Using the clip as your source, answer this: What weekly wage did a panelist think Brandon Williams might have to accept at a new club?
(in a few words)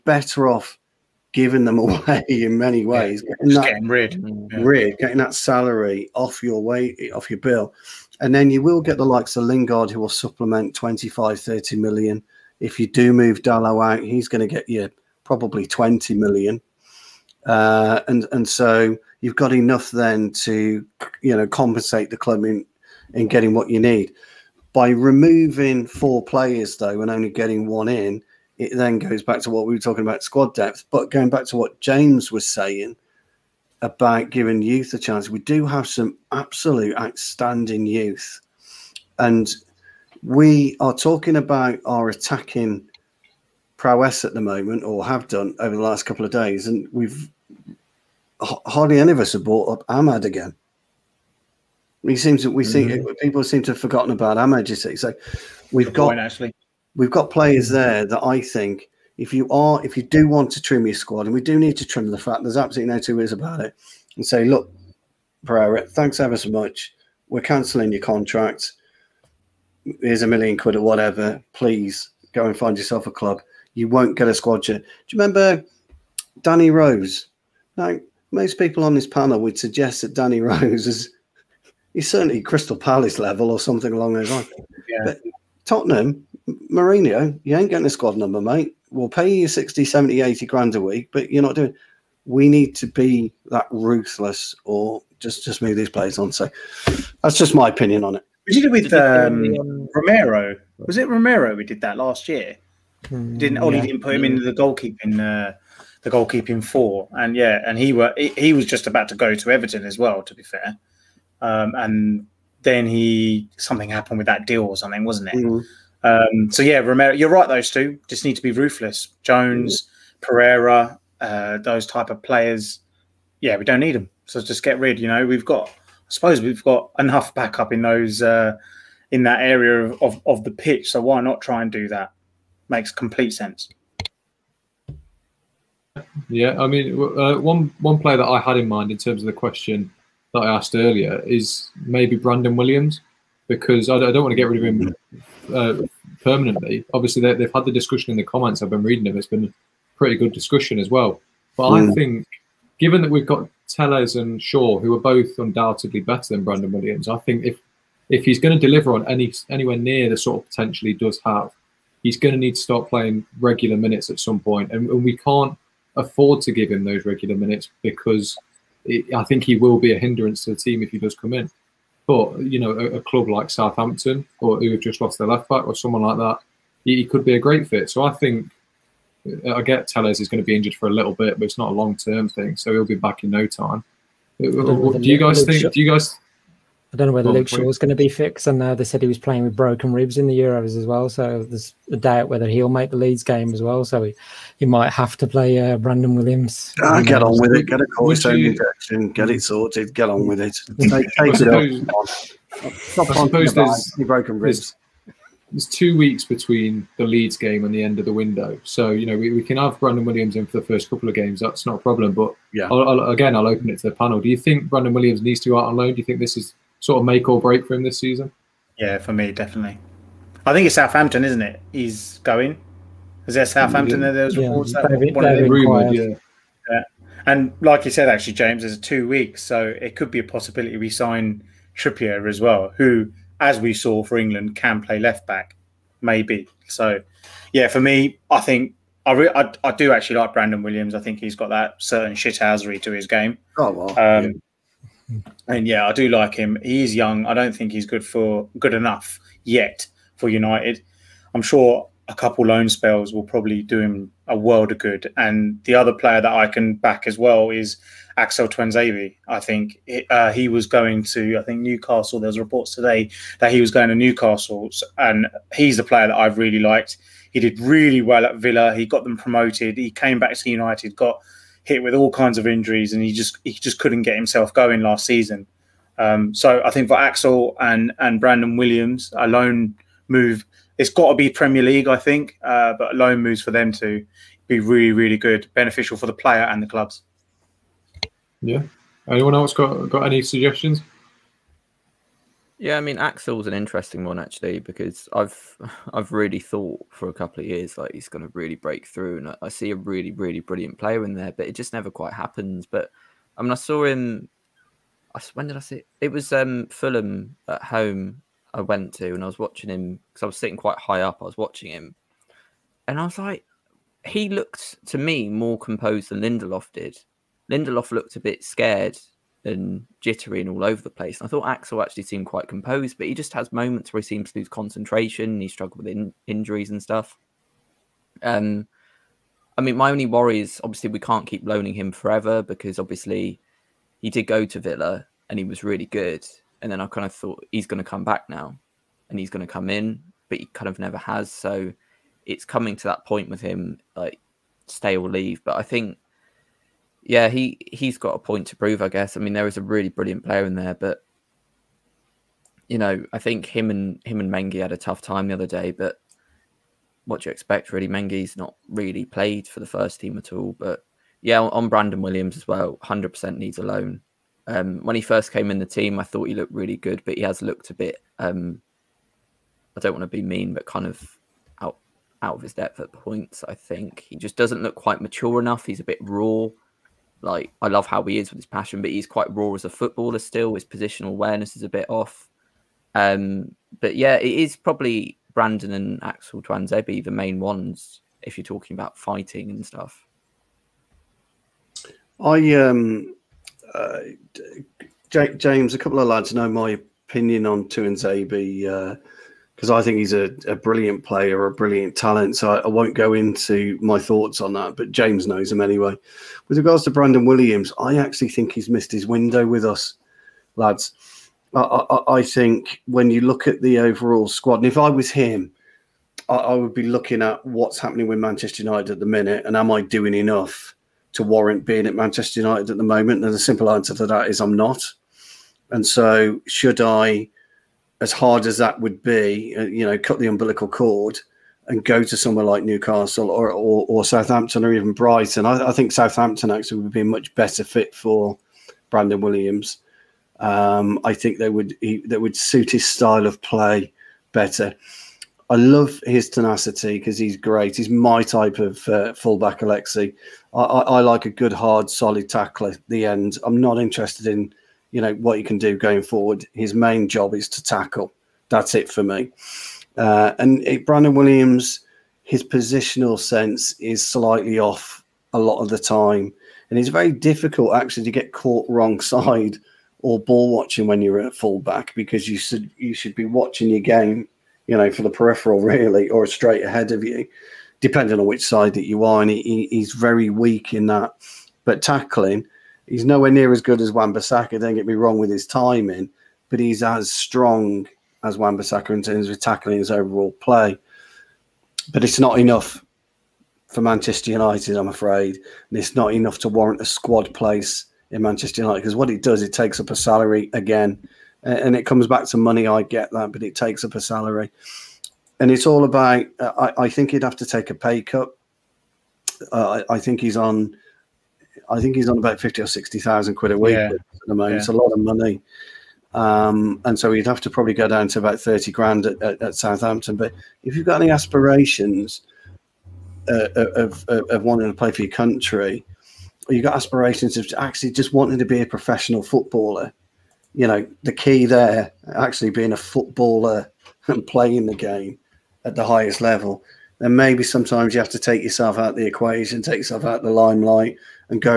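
30 grand.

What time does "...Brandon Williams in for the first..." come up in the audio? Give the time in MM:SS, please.
03:29.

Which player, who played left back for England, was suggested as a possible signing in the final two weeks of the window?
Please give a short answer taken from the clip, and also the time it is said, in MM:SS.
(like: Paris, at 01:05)
Trippier, at 03:51.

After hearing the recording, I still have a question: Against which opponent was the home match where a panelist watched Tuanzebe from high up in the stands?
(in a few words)
Fulham.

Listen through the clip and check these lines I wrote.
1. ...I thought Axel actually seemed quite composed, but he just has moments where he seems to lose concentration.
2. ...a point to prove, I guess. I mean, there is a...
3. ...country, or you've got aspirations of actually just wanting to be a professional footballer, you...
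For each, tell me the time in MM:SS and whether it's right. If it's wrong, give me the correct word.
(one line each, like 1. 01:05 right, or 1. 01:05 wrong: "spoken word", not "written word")
1. 05:21 right
2. 05:48 right
3. 08:45 right.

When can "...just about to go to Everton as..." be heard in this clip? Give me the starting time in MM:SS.
01:48.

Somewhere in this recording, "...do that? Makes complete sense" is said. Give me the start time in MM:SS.
02:11.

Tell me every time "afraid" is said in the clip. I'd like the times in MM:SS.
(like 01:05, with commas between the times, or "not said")
08:14.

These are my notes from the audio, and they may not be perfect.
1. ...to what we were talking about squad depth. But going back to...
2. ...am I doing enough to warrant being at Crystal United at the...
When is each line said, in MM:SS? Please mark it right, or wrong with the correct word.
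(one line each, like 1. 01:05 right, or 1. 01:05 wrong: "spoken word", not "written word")
1. 00:29 right
2. 06:59 wrong: "Manchester", not "Crystal".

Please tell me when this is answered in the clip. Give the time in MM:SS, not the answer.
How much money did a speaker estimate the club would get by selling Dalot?
00:15.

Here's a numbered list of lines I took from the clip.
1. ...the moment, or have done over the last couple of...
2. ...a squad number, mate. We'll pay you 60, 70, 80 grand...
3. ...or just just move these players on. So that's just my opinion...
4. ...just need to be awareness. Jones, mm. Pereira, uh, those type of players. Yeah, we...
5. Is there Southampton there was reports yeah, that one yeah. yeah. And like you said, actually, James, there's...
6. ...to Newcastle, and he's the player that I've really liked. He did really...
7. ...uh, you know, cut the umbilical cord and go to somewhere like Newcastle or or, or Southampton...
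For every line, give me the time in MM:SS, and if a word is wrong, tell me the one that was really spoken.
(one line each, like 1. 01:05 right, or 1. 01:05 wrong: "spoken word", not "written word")
1. 00:44 right
2. 01:27 right
3. 01:34 right
4. 01:58 wrong: "ruthless", not "awareness"
5. 03:43 right
6. 04:23 right
7. 07:09 right.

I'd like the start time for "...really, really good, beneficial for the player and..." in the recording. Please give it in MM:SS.
04:44.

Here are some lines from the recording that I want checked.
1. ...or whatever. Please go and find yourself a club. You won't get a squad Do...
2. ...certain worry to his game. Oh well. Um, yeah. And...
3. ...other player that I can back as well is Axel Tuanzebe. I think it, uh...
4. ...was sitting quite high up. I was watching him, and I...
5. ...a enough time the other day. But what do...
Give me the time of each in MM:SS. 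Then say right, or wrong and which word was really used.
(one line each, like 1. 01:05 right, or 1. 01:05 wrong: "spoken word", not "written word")
1. 01:10 right
2. 04:01 wrong: "shithousery", not "worry"
3. 04:15 right
4. 05:10 right
5. 05:54 wrong: "tough", not "enough".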